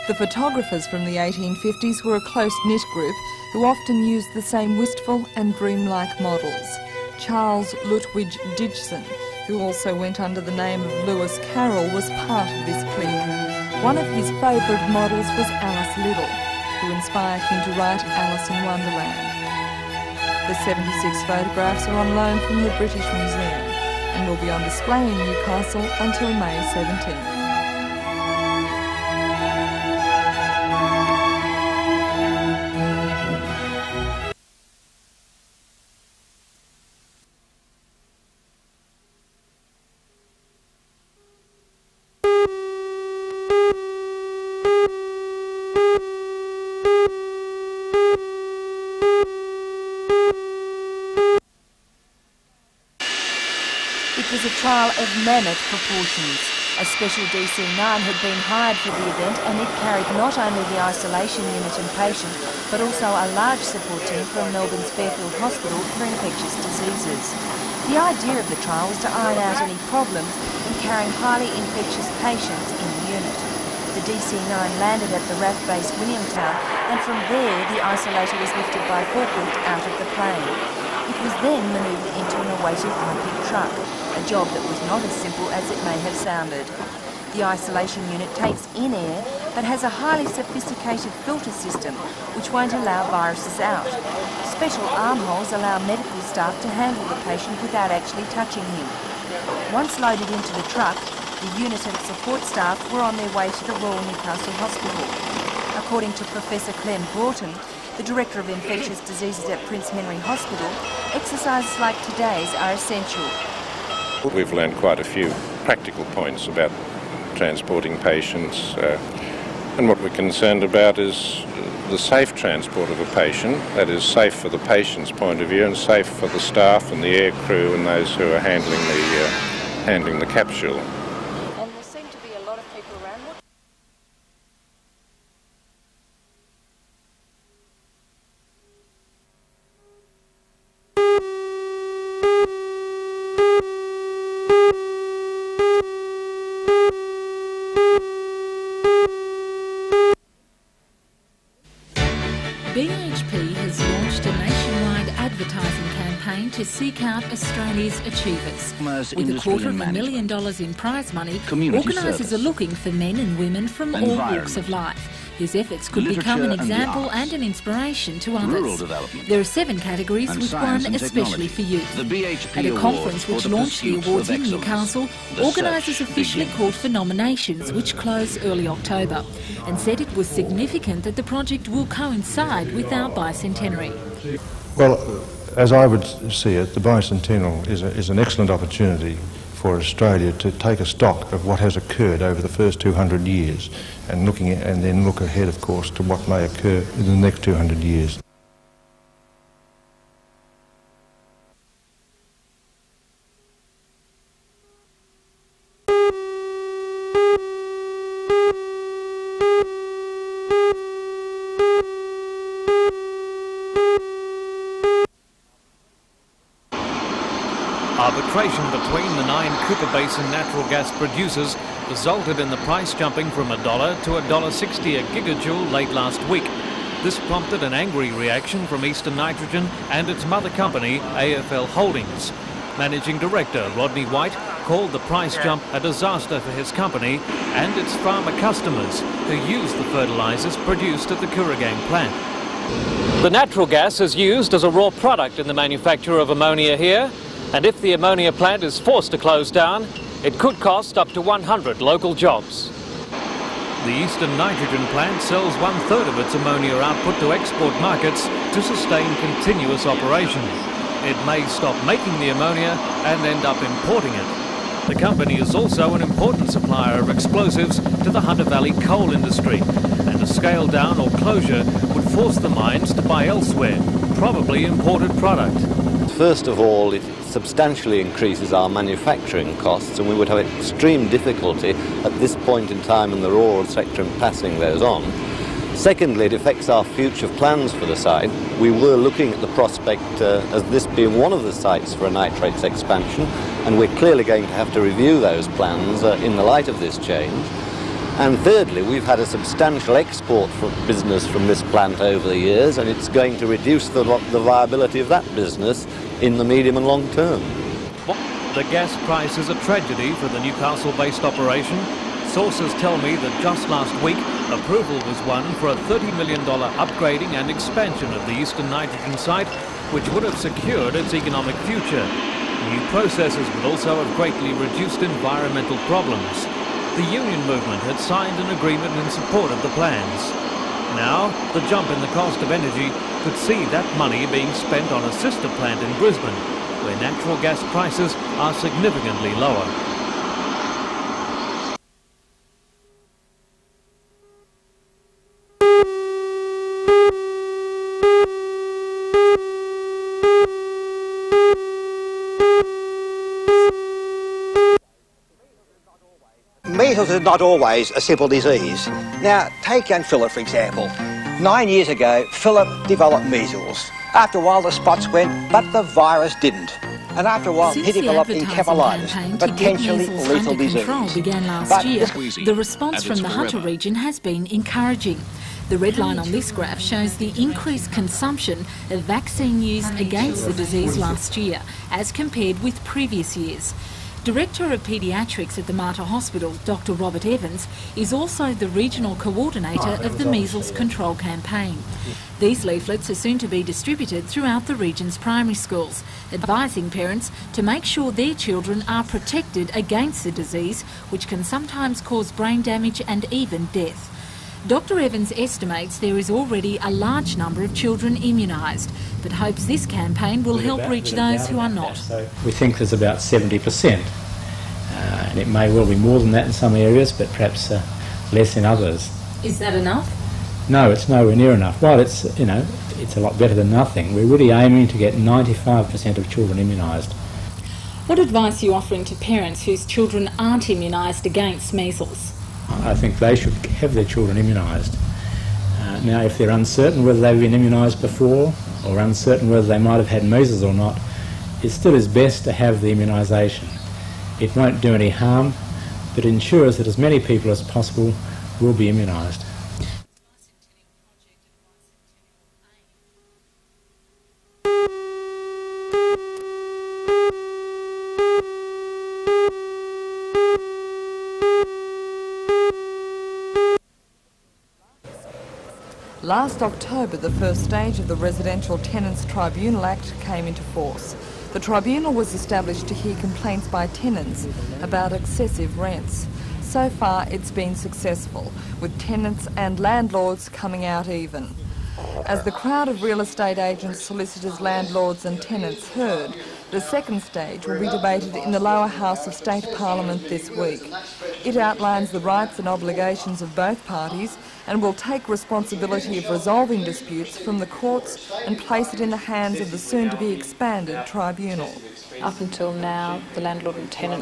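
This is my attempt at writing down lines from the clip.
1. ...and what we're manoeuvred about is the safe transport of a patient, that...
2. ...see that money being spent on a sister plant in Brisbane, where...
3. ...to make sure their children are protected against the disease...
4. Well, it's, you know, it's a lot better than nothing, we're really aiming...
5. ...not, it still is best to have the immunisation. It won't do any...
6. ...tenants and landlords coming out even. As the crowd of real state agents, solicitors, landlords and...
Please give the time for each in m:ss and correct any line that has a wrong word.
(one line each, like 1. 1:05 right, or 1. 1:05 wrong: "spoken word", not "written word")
1. 1:59 wrong: "concerned", not "manoeuvred"
2. 5:33 right
3. 6:37 right
4. 7:01 right
5. 7:20 right
6. 7:58 wrong: "estate", not "state".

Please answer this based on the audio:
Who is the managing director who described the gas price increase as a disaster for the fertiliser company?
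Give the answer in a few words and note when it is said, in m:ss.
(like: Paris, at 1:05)
Rodney White, at 3:53.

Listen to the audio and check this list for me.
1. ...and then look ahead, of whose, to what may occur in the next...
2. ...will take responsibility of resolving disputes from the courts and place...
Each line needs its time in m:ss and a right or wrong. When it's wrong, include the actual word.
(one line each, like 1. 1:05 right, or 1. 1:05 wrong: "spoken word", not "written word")
1. 3:14 wrong: "course", not "whose"
2. 8:14 right.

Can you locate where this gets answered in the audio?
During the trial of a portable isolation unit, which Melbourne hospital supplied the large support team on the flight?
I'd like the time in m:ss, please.
1:04.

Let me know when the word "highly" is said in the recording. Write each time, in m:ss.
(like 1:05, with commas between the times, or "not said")
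1:11, 1:29.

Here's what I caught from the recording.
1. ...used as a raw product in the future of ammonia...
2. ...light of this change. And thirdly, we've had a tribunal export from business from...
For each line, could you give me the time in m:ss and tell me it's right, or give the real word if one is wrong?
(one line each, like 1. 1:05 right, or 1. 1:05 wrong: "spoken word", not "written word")
1. 4:04 wrong: "manufacture", not "future"
2. 4:56 wrong: "substantial", not "tribunal".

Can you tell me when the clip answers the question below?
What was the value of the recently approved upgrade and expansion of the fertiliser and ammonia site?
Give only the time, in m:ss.
5:15.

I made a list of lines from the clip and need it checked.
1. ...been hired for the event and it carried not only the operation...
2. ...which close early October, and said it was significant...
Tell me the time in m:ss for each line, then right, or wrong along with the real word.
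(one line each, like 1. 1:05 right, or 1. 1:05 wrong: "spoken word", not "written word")
1. 0:58 wrong: "isolation", not "operation"
2. 2:57 right.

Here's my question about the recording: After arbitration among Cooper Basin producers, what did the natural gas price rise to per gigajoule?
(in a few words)
$1.60.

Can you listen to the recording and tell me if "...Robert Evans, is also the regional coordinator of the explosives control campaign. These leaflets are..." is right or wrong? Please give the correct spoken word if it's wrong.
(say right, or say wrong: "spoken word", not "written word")
wrong: "measles", not "explosives".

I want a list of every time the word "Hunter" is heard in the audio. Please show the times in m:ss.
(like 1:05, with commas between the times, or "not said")
4:28, 6:13.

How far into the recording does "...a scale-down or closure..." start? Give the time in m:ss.
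4:30.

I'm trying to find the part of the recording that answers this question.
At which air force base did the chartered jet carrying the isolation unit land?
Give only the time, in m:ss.
1:15.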